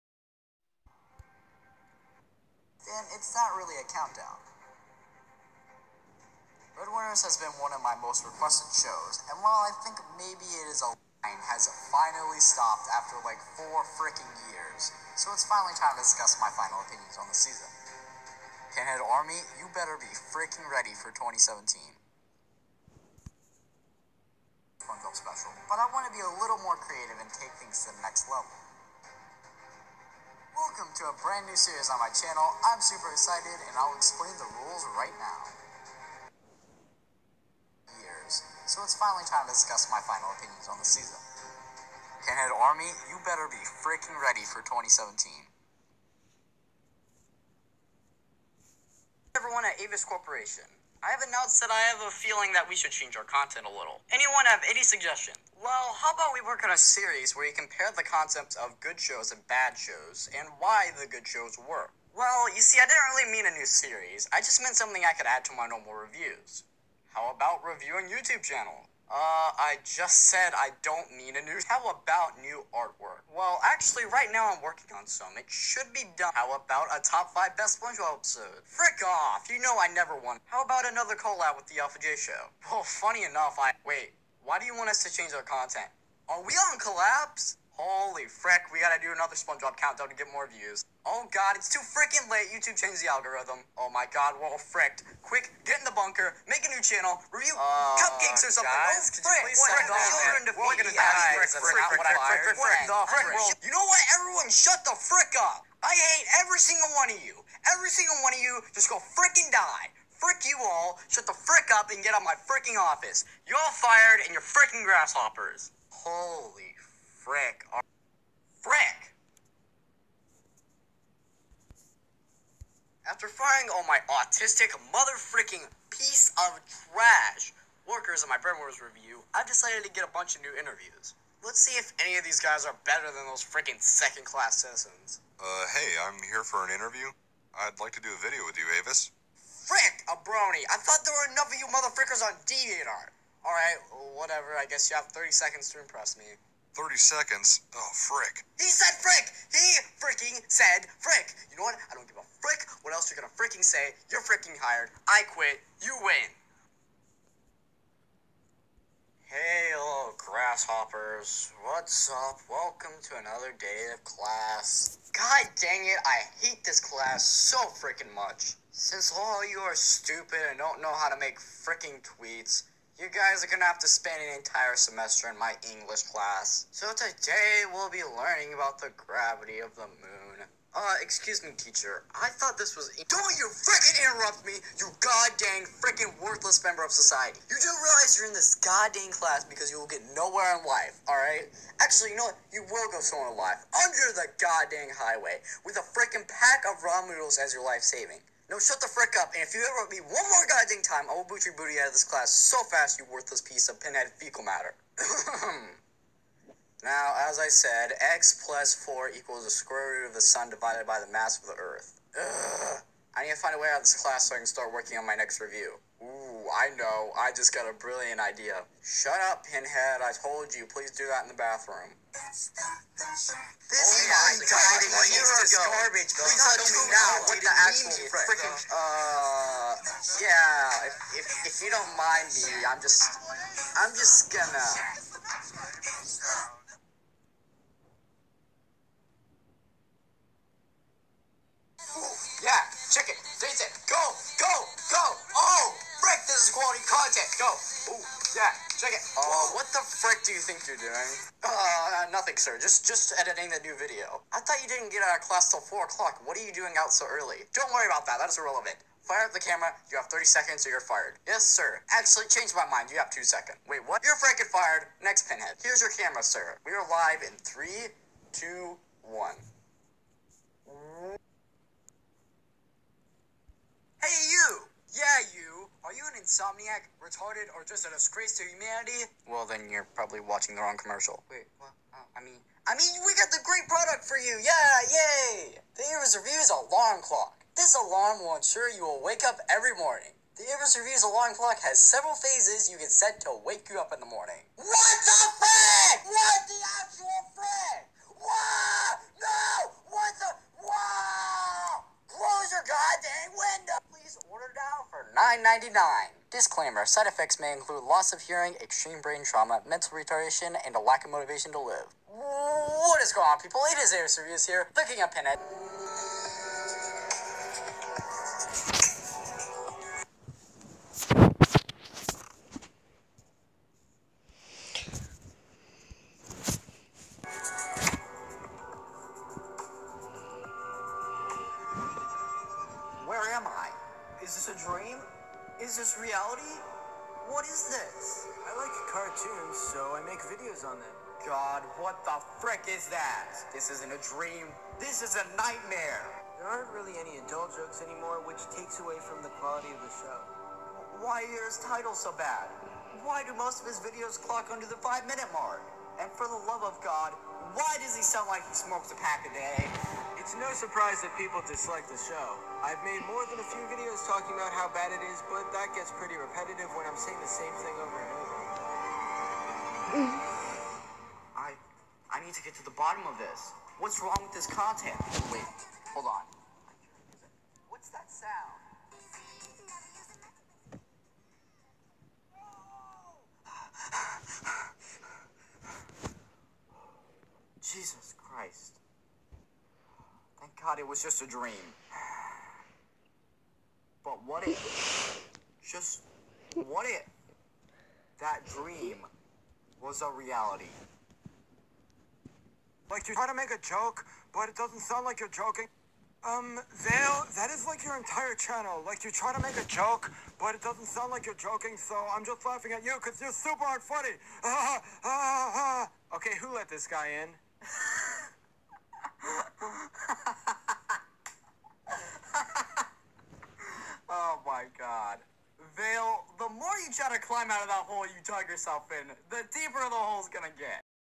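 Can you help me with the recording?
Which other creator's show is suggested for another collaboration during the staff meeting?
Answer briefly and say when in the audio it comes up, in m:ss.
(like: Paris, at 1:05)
Alpha J Show, at 1:21.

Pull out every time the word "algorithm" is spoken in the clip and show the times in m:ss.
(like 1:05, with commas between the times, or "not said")
1:33.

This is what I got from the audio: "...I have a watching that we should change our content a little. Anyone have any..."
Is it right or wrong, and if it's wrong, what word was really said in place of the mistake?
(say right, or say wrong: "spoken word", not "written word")
wrong: "feeling", not "watching".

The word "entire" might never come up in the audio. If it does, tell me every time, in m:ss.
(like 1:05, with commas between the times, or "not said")
2:54, 6:47.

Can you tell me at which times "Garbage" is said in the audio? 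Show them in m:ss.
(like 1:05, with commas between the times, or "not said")
3:45.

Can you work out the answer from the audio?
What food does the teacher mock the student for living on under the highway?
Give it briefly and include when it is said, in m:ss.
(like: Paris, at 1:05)
ramen noodles, at 3:16.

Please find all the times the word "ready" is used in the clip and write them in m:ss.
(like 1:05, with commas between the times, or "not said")
0:20, 0:44.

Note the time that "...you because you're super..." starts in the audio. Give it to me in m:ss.
6:52.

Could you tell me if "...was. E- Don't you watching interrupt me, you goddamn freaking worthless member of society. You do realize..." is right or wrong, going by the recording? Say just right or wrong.
wrong.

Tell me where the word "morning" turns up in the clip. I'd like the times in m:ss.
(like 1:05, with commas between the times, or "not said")
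4:49, 4:54.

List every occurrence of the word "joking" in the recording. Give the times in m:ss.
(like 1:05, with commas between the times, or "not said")
6:45, 6:51.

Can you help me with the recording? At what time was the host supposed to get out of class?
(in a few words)
4 o'clock.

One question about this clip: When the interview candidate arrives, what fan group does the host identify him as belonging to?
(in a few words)
brony.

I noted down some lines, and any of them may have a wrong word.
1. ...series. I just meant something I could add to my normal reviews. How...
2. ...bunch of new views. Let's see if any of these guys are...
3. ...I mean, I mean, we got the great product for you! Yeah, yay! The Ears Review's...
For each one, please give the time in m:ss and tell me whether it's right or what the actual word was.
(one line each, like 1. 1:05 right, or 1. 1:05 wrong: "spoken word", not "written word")
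1. 1:03 right
2. 2:10 wrong: "interviews", not "views"
3. 4:42 right.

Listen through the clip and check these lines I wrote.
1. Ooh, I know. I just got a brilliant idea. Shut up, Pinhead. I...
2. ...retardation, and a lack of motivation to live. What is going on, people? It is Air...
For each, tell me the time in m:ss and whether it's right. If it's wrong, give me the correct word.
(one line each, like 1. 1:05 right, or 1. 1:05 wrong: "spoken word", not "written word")
1. 3:35 right
2. 5:09 right.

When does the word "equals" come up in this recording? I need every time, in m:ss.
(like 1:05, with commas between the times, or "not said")
3:29.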